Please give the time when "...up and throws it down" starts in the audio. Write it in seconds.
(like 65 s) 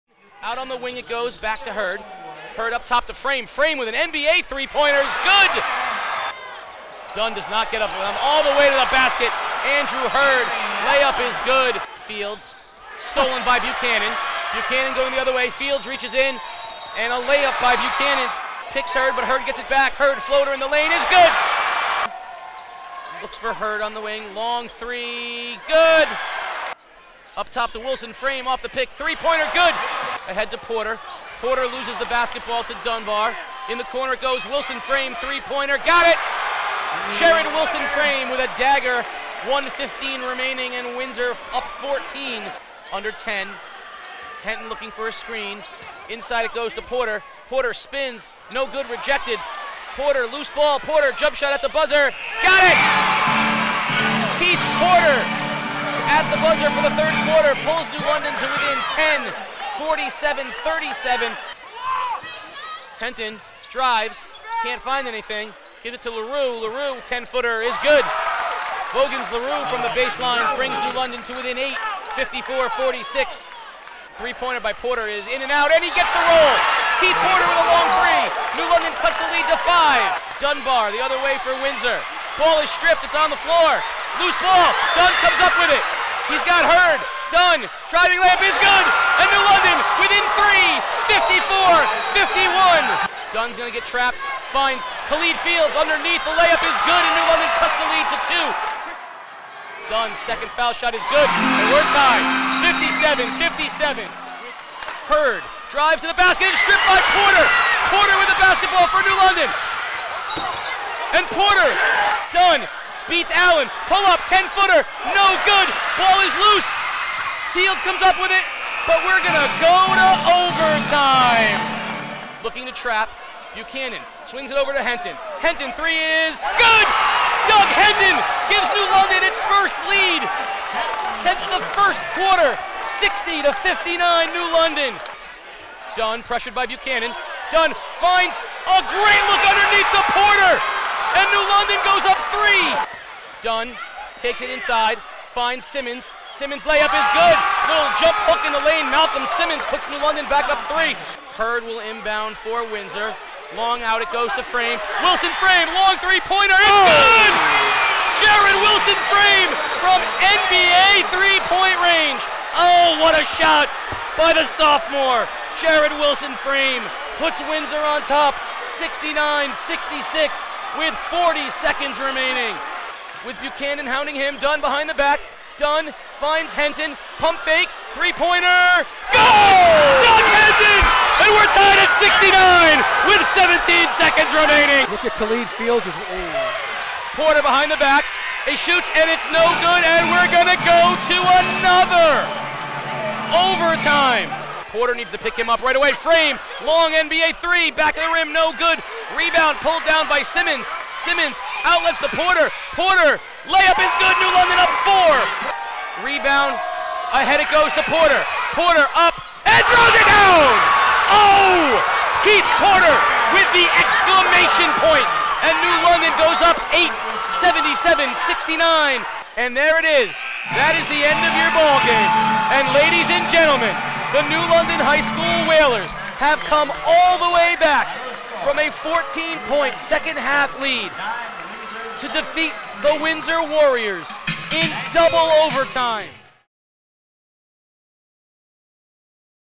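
208 s.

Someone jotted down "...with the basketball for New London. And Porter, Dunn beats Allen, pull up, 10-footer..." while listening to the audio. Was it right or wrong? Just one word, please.
right.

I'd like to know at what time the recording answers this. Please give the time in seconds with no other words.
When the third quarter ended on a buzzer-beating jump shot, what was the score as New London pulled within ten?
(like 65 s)
59 s.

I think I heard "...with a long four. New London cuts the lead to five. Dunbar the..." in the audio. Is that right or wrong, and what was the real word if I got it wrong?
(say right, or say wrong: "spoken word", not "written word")
wrong: "three", not "four".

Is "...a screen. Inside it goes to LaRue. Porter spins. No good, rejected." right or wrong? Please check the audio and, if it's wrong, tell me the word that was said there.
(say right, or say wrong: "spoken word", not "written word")
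wrong: "Porter", not "LaRue".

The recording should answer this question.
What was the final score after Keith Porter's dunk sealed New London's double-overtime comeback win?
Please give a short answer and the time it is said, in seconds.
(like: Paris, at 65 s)
77-69, at 217 s.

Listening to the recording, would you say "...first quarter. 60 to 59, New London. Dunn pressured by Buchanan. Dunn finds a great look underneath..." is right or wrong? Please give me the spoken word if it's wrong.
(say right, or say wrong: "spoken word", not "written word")
right.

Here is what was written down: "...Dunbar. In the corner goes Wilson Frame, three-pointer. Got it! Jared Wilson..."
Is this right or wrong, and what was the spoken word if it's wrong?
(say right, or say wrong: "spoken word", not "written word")
right.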